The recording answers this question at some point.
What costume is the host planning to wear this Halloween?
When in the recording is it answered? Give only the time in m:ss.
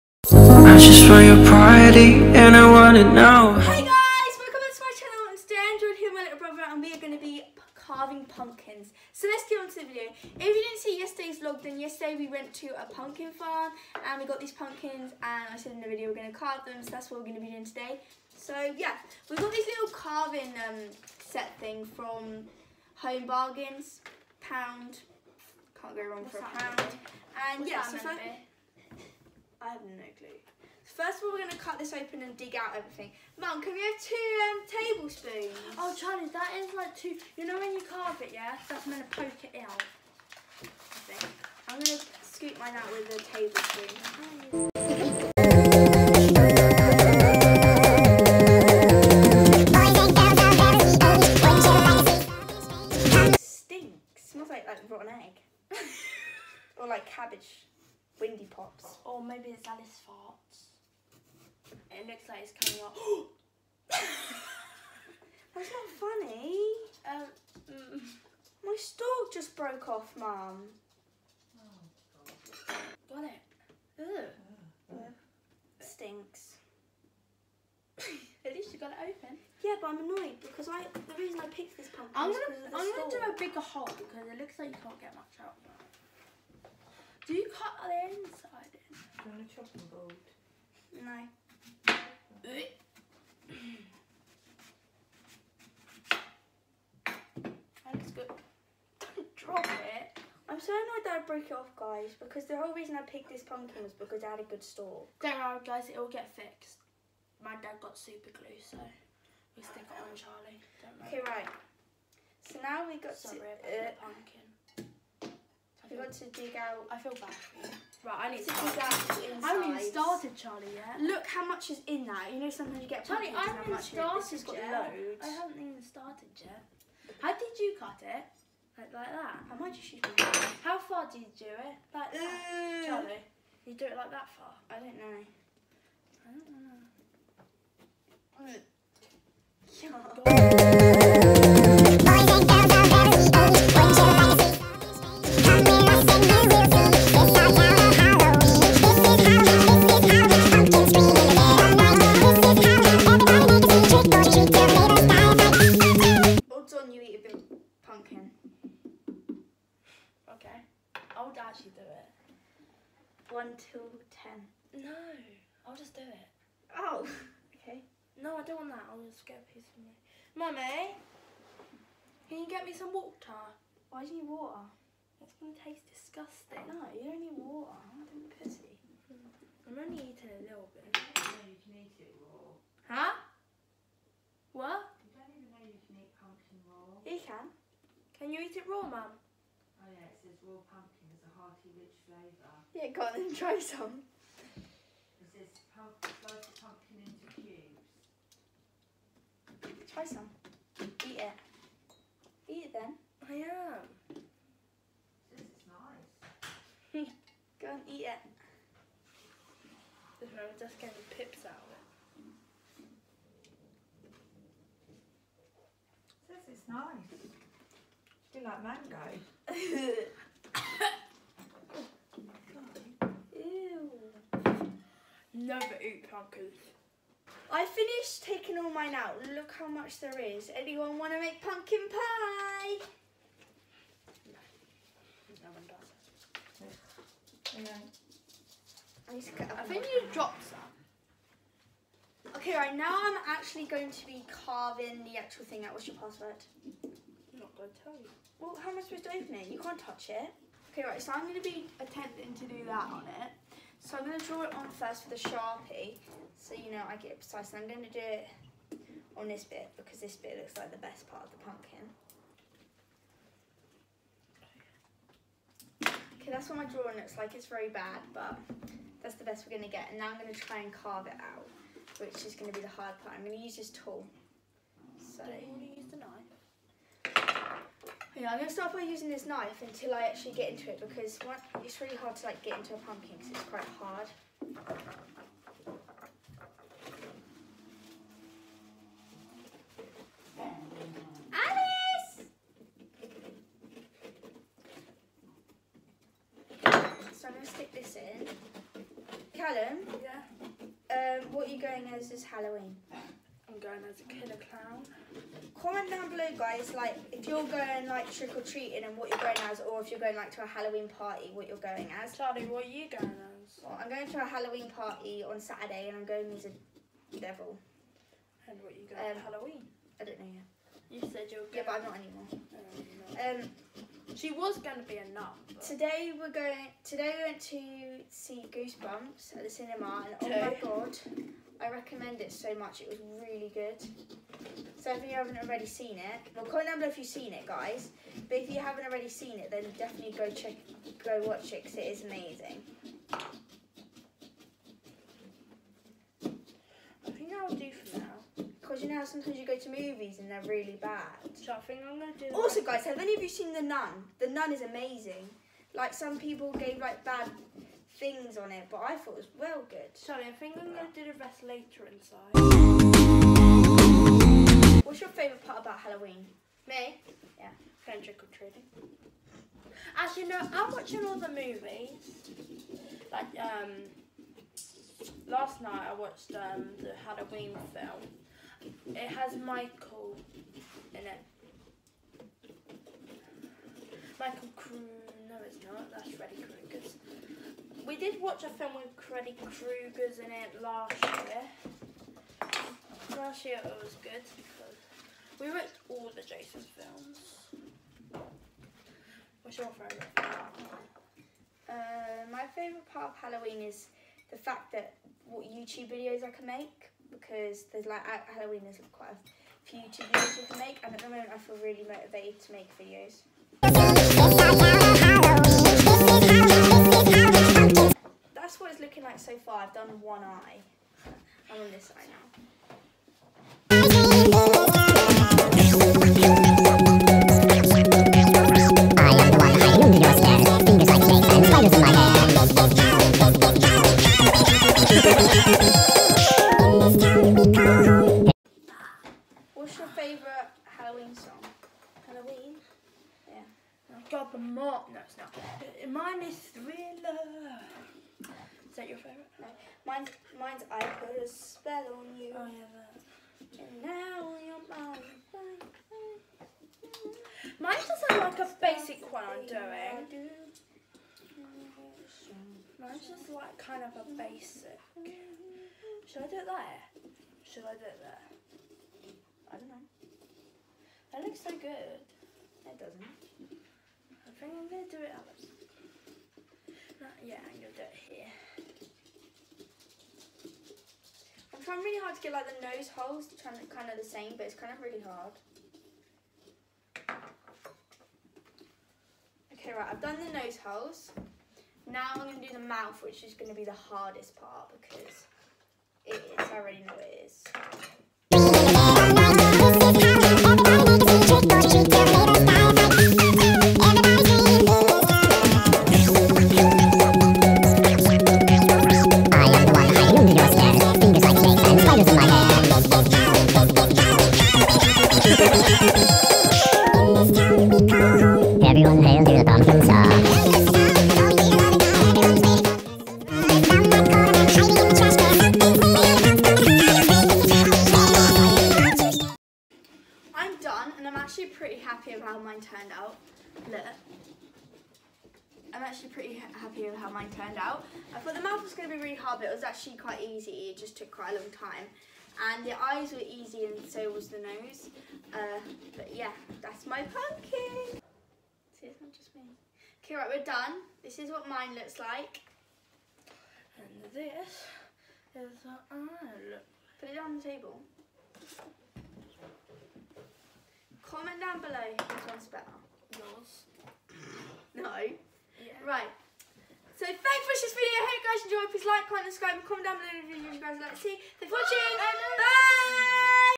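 5:04.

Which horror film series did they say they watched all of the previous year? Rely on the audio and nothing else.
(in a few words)
the Jason films.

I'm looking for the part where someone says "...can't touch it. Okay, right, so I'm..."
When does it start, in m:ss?
4:09.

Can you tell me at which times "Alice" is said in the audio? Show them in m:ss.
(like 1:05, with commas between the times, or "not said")
0:59, 4:51.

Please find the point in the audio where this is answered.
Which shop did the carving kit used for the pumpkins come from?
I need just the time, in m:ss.
0:23.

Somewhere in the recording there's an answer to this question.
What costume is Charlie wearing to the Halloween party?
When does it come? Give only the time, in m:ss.
5:17.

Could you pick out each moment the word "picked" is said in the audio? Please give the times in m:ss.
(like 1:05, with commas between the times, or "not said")
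1:21, 1:43.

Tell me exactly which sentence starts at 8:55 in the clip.
actually pretty happy with how mine turned out.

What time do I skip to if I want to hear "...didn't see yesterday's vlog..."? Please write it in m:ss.
0:10.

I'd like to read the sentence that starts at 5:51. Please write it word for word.
So I think I'm going to do Also, guys, have any of you seen The Nun?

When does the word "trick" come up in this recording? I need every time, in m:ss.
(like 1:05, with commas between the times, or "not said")
5:08, 6:08.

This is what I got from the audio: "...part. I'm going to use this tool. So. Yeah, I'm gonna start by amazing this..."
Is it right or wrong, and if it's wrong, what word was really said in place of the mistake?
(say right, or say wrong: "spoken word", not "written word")
wrong: "using", not "amazing".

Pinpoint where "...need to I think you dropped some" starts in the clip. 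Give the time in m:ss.
3:59.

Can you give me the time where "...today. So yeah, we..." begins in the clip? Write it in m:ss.
0:17.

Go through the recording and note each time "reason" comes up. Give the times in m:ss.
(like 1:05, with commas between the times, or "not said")
1:21, 1:42.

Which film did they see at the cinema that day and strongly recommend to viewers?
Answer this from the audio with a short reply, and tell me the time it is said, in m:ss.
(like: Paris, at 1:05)
Goosebumps, at 5:28.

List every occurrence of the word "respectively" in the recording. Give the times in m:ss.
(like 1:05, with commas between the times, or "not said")
not said.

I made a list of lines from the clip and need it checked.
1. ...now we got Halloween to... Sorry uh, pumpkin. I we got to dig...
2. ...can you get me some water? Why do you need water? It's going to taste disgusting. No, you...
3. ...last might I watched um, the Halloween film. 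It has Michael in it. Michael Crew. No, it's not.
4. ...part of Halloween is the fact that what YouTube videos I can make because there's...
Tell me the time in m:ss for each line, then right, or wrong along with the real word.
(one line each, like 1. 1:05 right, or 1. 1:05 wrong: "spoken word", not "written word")
1. 1:52 wrong: "Sorry", not "Halloween"
2. 2:52 right
3. 6:15 wrong: "night", not "might"
4. 6:42 right.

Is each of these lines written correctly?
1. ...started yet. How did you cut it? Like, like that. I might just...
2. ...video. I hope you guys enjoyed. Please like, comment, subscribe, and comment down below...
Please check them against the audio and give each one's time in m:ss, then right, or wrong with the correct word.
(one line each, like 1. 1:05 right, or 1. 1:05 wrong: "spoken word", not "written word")
1. 2:05 right
2. 9:27 right.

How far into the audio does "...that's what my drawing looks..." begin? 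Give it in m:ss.
4:26.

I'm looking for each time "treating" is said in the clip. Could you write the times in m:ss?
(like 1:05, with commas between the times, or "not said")
5:08, 6:08.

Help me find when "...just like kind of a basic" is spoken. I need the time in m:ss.
7:43.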